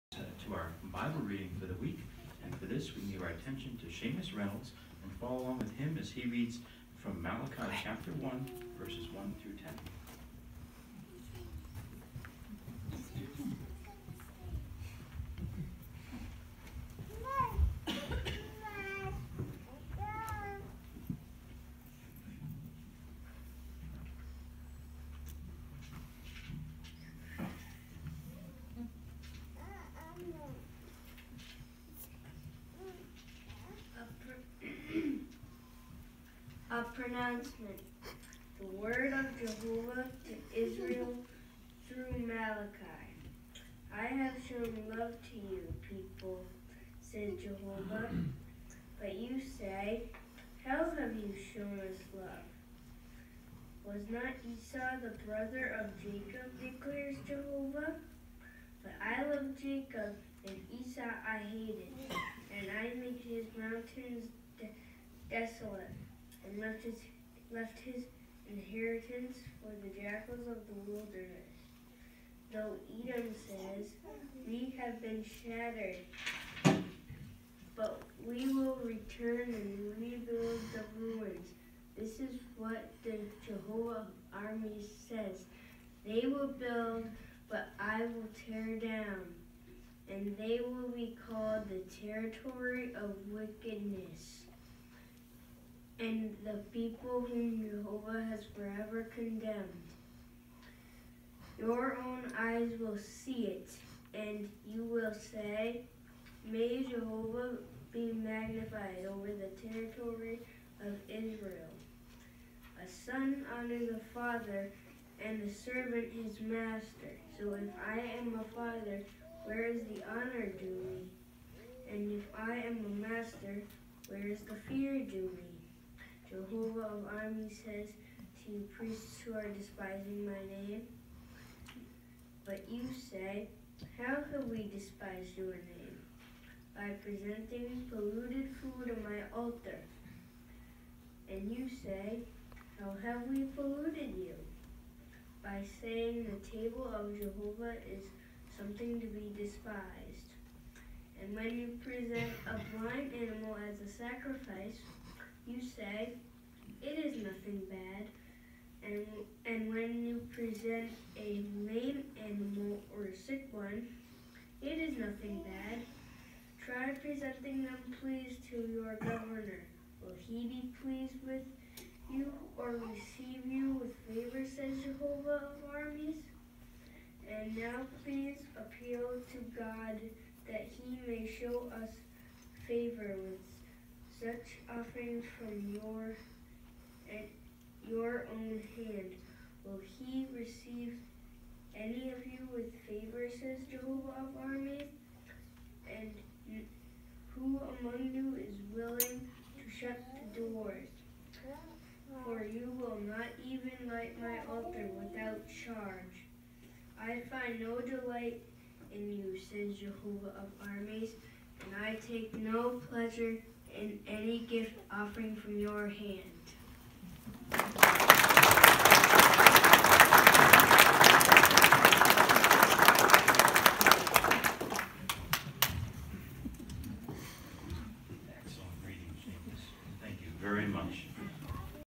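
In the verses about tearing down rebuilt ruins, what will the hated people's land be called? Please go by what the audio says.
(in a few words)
territory of wickedness.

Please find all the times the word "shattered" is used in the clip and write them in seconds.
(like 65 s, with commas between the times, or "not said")
75 s.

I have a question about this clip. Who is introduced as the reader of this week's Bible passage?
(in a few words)
Seamus Reynolds.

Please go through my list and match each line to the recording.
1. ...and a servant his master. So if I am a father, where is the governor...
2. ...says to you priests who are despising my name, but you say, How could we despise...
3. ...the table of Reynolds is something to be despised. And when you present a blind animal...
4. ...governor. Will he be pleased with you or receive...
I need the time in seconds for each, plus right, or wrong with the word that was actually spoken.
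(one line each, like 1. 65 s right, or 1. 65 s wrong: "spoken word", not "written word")
1. 115 s wrong: "honor", not "governor"
2. 127 s right
3. 146 s wrong: "Jehovah", not "Reynolds"
4. 168 s right.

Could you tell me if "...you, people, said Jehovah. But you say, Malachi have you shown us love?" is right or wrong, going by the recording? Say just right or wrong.
wrong.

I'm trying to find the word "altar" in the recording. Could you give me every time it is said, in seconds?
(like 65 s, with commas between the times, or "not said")
139 s, 204 s.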